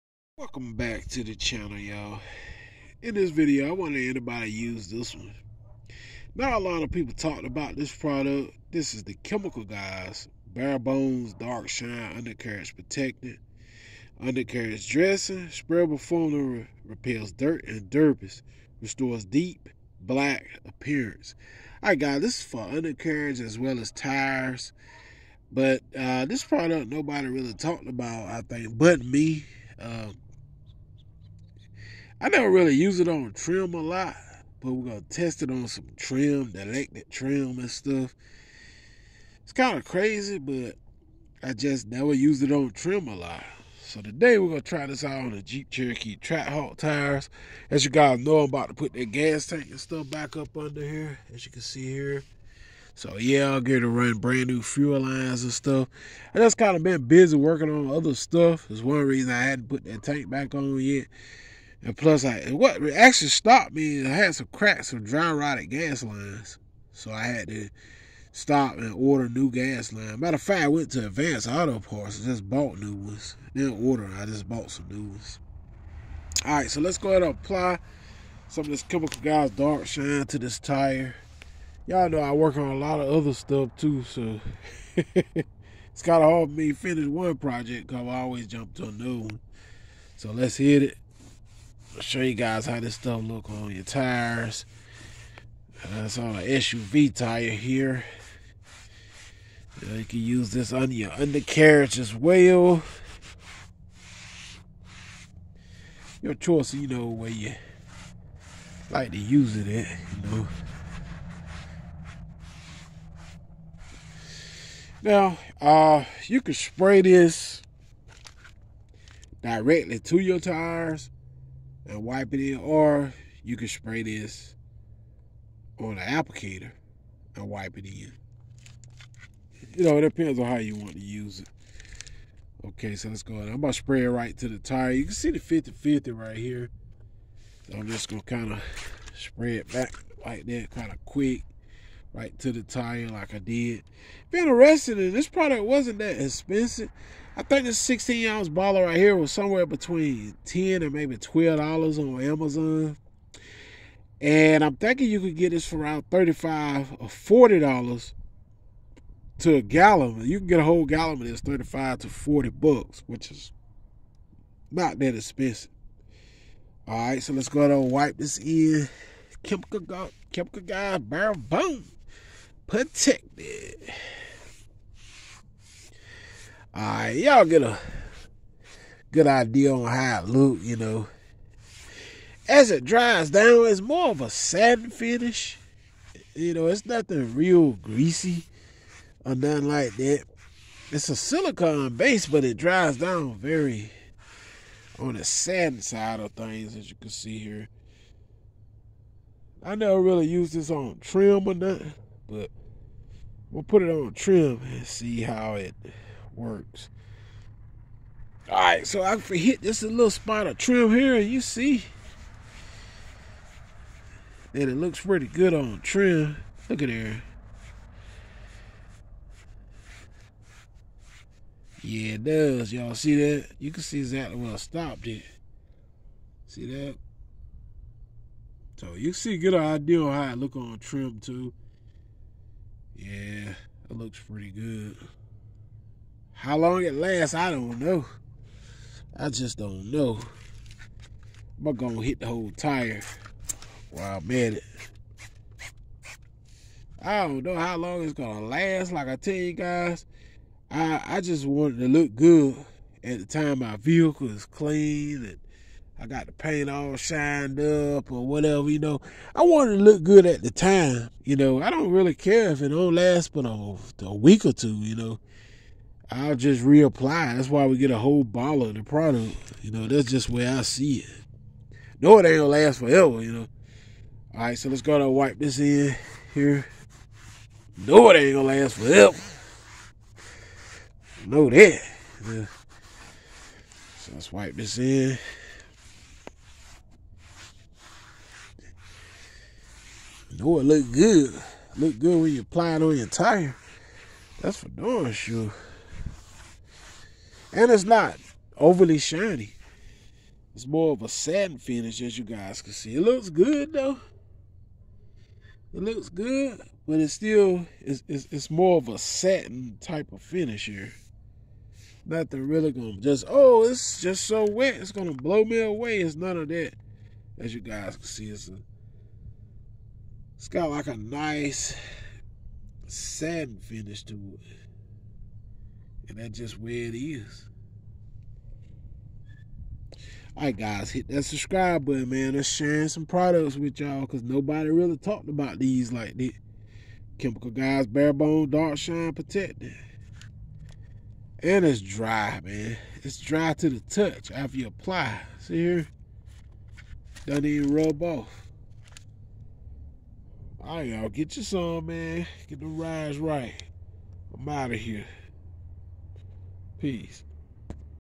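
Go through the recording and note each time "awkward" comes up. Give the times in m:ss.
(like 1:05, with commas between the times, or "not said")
not said.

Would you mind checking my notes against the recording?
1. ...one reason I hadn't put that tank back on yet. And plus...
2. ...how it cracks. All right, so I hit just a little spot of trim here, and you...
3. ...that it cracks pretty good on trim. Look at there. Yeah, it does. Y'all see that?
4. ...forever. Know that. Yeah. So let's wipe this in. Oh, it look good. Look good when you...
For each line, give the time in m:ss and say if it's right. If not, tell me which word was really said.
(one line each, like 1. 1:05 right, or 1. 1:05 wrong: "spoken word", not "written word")
1. 0:58 right
2. 3:25 wrong: "works", not "cracks"
3. 3:34 wrong: "looks", not "cracks"
4. 4:38 right.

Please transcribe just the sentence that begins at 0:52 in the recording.
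So yeah, I'll get to run brand new fuel lines and stuff.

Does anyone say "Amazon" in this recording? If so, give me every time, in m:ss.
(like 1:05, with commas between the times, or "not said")
2:32.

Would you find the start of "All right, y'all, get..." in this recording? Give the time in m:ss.
5:50.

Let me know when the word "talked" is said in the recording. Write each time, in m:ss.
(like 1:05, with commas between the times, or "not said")
0:07, 0:27, 5:34.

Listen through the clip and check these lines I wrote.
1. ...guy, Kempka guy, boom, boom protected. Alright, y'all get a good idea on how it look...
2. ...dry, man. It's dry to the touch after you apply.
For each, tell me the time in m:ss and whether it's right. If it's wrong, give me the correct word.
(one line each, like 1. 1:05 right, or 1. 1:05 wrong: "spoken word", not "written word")
1. 2:49 right
2. 5:41 right.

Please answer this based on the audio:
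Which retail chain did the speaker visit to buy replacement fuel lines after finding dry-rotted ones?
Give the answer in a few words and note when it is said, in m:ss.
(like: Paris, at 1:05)
Advanced Auto Parts, at 1:11.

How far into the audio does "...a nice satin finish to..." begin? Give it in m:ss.
5:20.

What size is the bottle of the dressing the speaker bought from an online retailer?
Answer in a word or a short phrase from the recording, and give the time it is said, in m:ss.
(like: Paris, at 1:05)
16 ounce, at 2:27.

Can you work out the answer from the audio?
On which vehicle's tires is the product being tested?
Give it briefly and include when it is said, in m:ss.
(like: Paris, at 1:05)
Jeep Cherokee Trackhawk, at 0:45.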